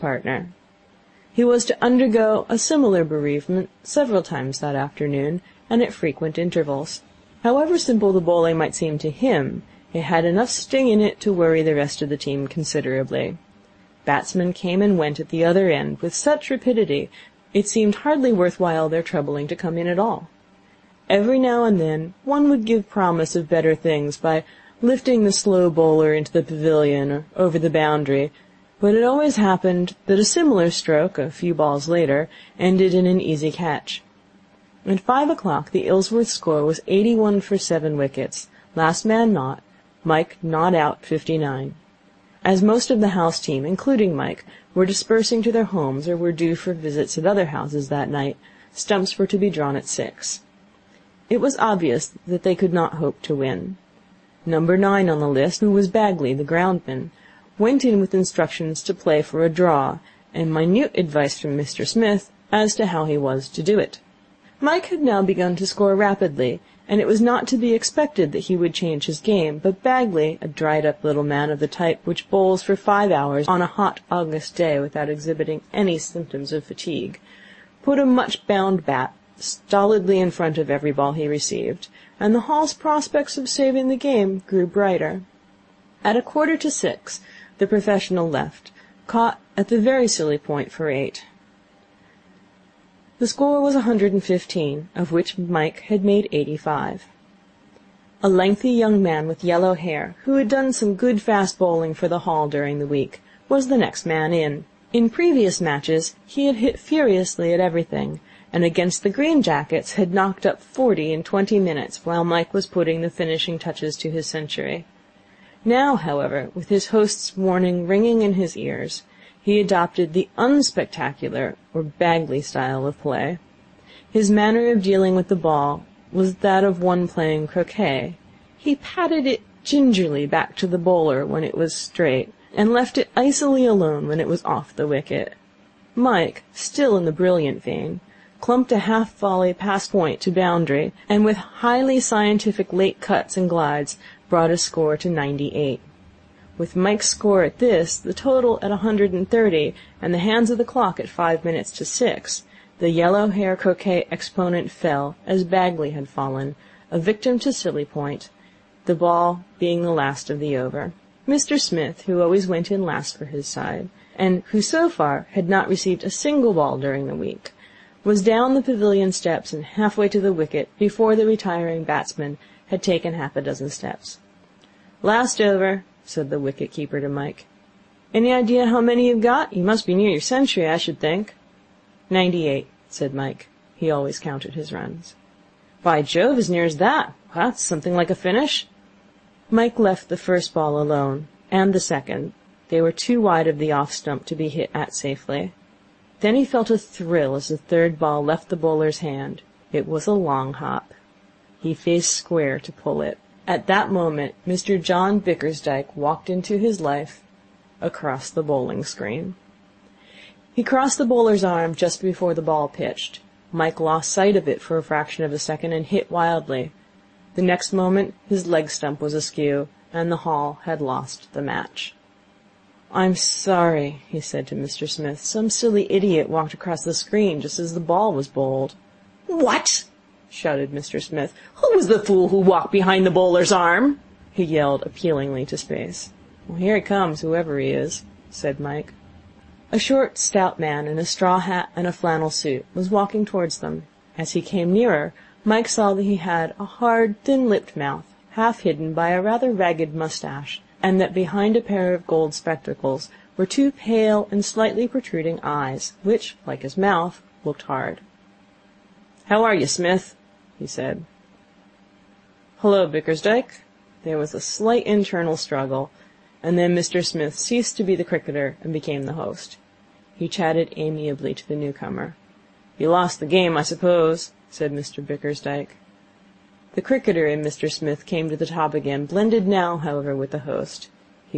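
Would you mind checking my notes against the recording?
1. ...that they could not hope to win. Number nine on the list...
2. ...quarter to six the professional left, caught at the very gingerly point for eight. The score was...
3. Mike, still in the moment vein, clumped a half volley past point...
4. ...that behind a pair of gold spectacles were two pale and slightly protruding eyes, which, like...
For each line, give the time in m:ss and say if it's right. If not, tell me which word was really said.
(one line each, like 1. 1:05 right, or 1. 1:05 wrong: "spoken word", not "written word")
1. 0:52 right
2. 1:26 wrong: "silly", not "gingerly"
3. 2:15 wrong: "brilliant", not "moment"
4. 4:11 right.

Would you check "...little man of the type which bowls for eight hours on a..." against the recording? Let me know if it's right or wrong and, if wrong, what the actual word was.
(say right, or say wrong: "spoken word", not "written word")
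wrong: "five", not "eight".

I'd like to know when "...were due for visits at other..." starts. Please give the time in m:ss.
0:46.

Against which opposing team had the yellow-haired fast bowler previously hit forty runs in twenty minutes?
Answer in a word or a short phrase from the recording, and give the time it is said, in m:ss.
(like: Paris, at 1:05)
Green Jackets, at 1:49.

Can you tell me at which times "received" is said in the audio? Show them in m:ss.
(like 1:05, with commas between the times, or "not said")
1:21, 2:45.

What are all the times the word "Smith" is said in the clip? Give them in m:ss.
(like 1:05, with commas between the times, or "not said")
1:01, 2:41, 3:44, 3:51, 4:19, 4:27, 4:37.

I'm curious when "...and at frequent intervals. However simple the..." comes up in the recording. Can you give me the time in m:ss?
0:05.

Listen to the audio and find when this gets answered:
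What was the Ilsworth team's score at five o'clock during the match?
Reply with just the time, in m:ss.
0:36.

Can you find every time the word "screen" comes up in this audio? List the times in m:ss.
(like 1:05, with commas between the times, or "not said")
3:28, 3:46.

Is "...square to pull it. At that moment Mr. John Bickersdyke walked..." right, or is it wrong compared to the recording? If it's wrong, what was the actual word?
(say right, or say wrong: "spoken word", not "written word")
right.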